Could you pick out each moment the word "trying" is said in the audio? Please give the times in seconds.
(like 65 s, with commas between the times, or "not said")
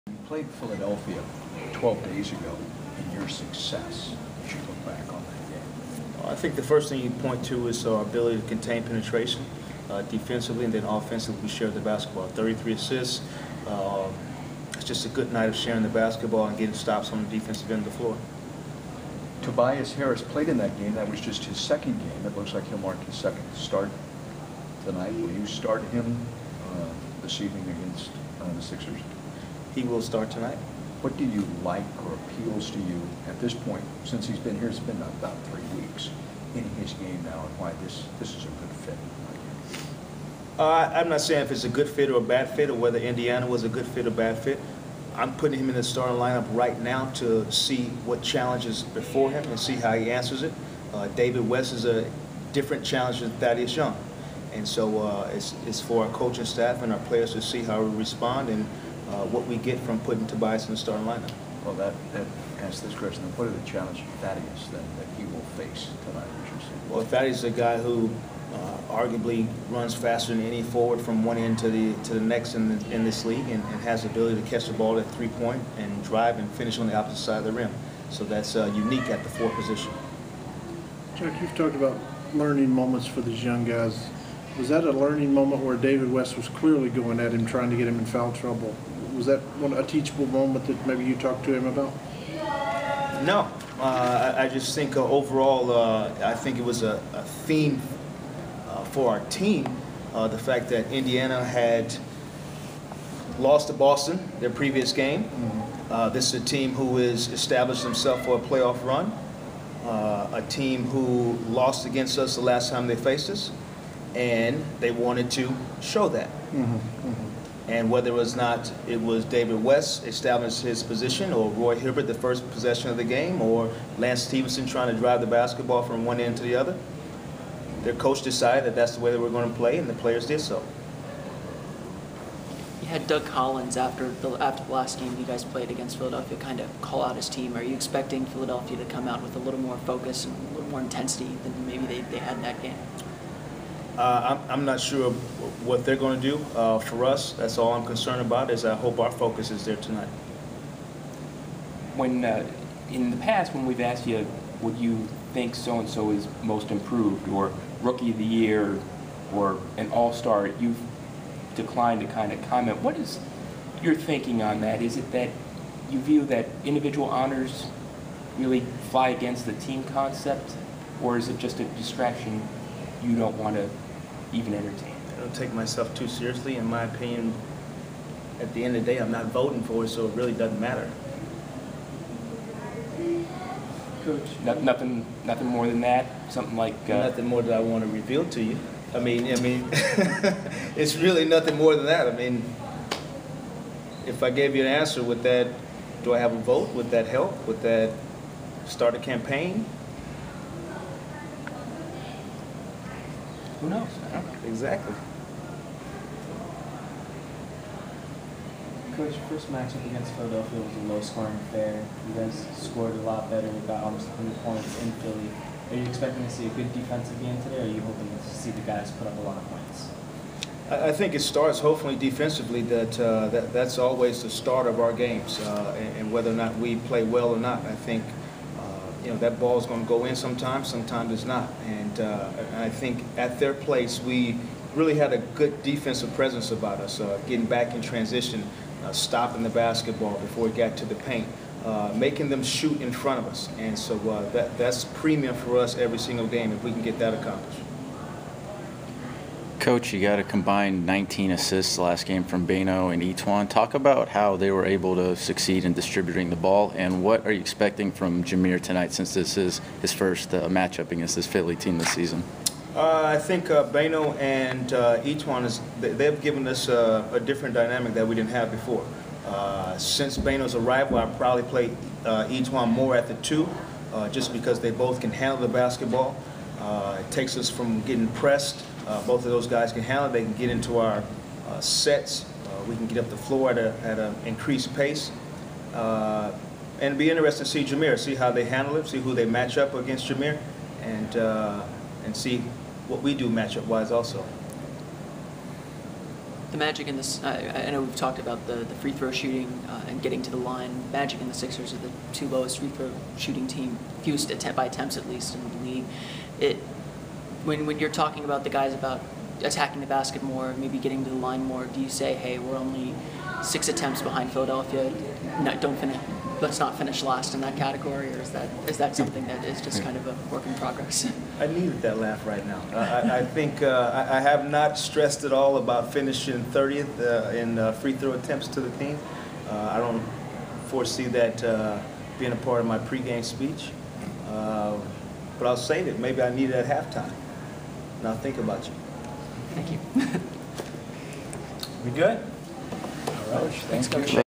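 87 s, 124 s.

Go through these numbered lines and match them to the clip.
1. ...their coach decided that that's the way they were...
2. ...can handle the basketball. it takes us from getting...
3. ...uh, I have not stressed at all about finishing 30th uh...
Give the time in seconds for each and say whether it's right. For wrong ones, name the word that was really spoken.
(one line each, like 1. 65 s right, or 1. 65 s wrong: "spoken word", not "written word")
1. 127 s right
2. 274 s right
3. 323 s right.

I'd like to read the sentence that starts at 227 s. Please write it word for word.
I think you know, that is going to go in sometimes, sometimes it's not.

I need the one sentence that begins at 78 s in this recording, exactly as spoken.
So that's uh, unique at the four position.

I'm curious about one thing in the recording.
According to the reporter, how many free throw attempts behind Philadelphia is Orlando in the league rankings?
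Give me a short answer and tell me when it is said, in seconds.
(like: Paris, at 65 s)
6, at 313 s.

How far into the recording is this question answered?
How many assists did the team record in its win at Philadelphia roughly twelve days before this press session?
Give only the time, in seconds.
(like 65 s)
12 s.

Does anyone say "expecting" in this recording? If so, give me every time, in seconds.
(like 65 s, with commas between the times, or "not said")
137 s, 215 s, 257 s.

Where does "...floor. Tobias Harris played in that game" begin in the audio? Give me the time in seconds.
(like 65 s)
17 s.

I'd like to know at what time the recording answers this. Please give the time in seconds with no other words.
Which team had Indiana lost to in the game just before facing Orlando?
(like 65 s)
103 s.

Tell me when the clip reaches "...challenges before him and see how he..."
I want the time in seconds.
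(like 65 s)
48 s.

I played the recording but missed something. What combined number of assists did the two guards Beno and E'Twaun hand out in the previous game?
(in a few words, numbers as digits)
19.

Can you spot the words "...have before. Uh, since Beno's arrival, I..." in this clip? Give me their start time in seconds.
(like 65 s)
268 s.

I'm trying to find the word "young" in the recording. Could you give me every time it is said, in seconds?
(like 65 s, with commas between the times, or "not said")
53 s, 83 s.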